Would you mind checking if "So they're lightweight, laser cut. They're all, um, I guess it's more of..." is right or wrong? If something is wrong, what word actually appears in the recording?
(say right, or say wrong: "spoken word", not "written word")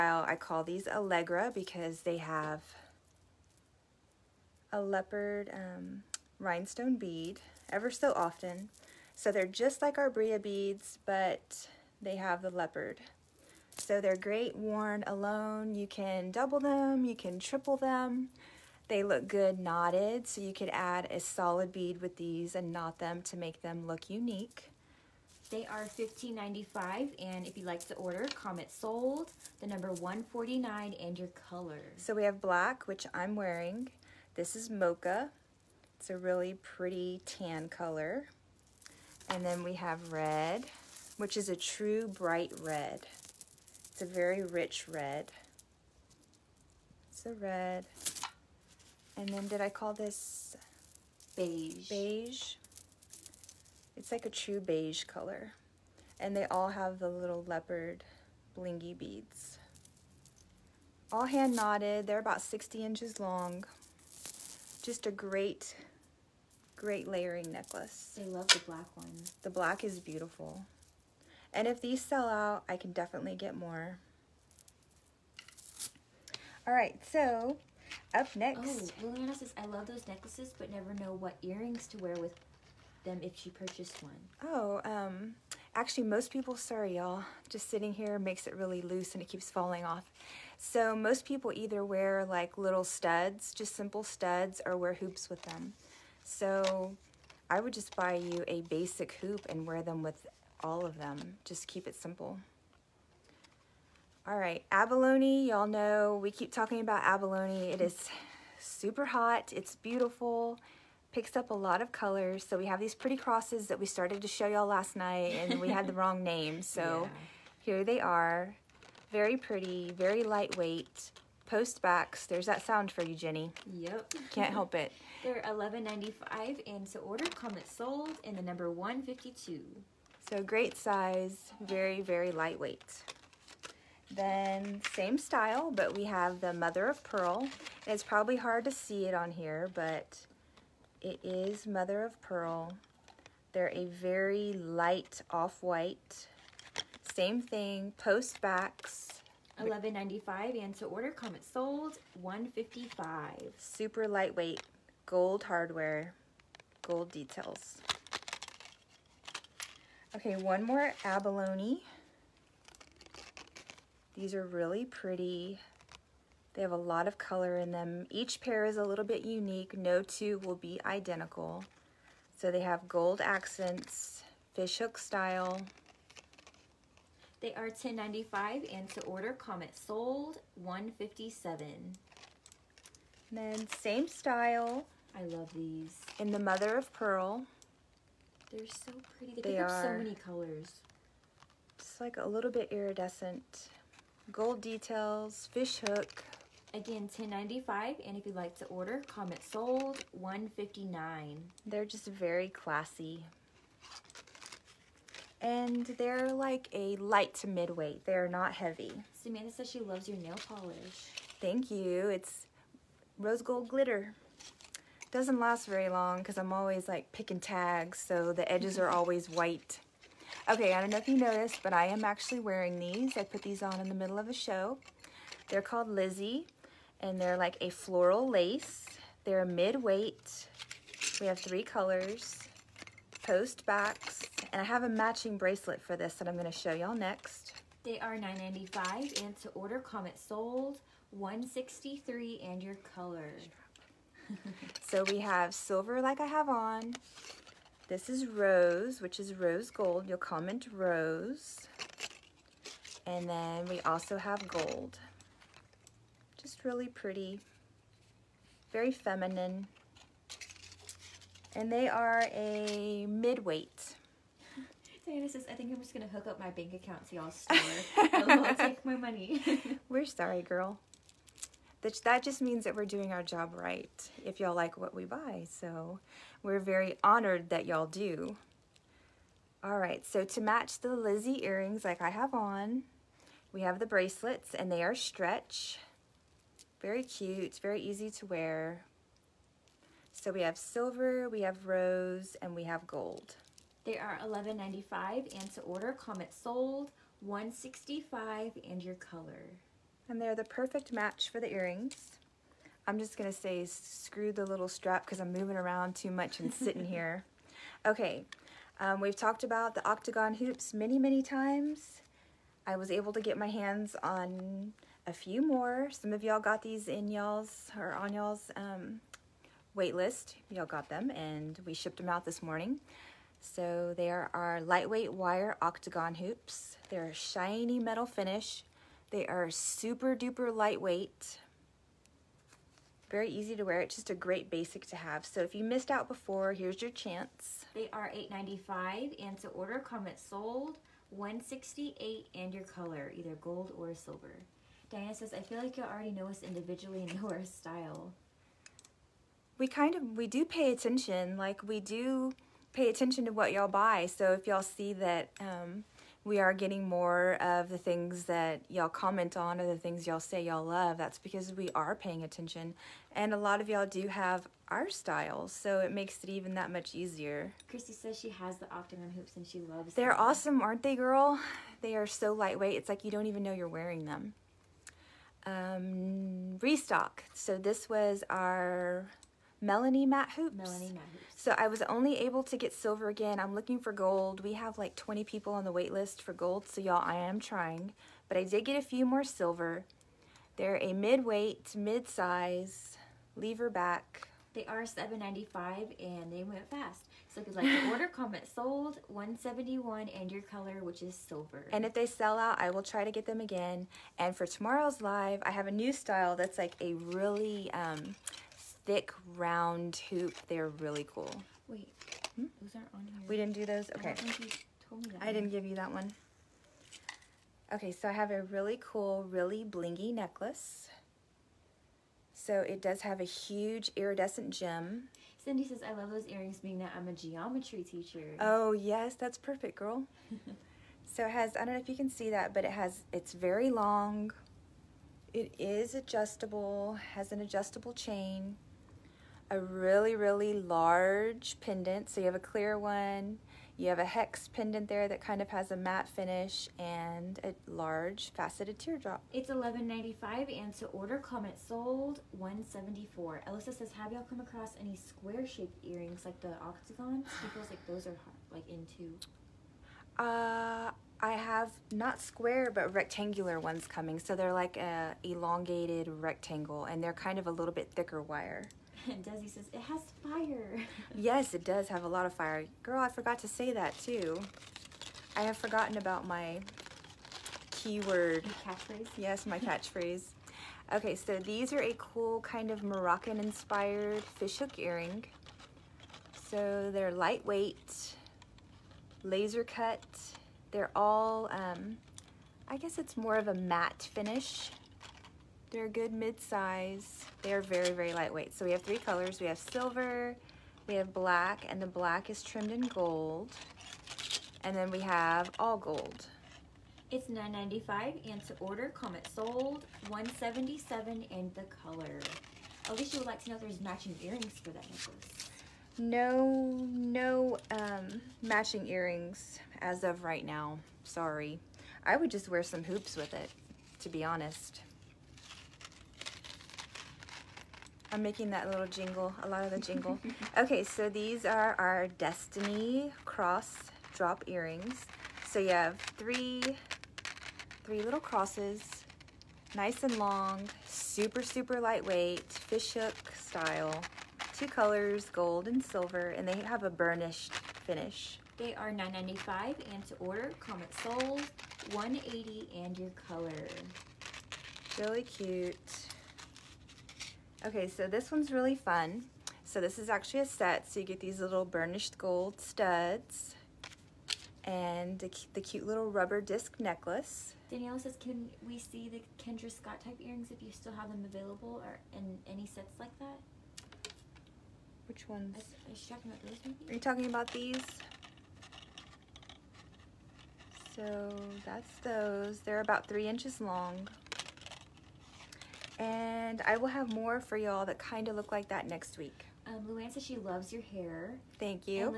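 right.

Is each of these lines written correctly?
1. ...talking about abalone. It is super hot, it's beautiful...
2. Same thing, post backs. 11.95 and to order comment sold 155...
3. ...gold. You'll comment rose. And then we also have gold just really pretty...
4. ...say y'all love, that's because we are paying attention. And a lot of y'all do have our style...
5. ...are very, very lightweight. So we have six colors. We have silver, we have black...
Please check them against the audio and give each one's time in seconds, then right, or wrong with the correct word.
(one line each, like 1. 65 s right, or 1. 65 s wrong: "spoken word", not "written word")
1. 106 s right
2. 147 s right
3. 249 s right
4. 360 s right
5. 497 s wrong: "three", not "six".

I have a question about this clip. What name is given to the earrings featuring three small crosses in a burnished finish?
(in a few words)
Destiny.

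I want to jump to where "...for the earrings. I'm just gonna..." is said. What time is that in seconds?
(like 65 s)
301 s.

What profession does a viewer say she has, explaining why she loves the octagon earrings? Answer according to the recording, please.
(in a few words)
Geometry teacher.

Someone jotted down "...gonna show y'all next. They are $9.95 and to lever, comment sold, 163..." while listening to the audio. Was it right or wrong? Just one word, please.
wrong.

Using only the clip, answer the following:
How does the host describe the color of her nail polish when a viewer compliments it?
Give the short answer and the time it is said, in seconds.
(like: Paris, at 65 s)
Rose gold glitter, at 213 s.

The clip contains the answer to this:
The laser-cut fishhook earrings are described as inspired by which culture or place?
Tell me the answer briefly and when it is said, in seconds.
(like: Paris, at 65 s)
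Moroccan, at 482 s.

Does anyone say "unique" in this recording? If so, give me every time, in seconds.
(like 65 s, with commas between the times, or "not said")
24 s, 169 s.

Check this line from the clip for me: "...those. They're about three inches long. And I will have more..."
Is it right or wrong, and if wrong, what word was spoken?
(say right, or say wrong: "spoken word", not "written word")
right.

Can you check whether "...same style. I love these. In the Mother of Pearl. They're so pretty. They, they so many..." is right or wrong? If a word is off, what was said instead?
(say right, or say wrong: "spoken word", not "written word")
right.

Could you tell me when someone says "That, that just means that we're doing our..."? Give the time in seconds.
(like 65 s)
271 s.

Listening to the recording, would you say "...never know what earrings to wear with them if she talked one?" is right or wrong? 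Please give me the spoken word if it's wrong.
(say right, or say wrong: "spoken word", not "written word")
wrong: "purchased", not "talked".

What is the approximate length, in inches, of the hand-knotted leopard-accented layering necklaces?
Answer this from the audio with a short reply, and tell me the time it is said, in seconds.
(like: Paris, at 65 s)
60 inches, at 62 s.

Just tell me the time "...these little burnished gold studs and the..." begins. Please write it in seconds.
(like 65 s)
561 s.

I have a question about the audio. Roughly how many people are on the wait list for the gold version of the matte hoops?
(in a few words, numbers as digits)
20.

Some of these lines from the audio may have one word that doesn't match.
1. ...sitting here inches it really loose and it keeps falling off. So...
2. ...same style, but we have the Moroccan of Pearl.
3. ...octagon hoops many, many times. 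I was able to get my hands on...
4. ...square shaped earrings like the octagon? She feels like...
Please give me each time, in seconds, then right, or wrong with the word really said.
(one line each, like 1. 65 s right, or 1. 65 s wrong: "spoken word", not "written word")
1. 87 s wrong: "makes", not "inches"
2. 134 s wrong: "Mother", not "Moroccan"
3. 309 s right
4. 454 s right.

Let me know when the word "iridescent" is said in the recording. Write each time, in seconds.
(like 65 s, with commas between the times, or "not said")
192 s, 423 s.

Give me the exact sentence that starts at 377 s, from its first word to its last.
So this was our Melanie matte Hoops.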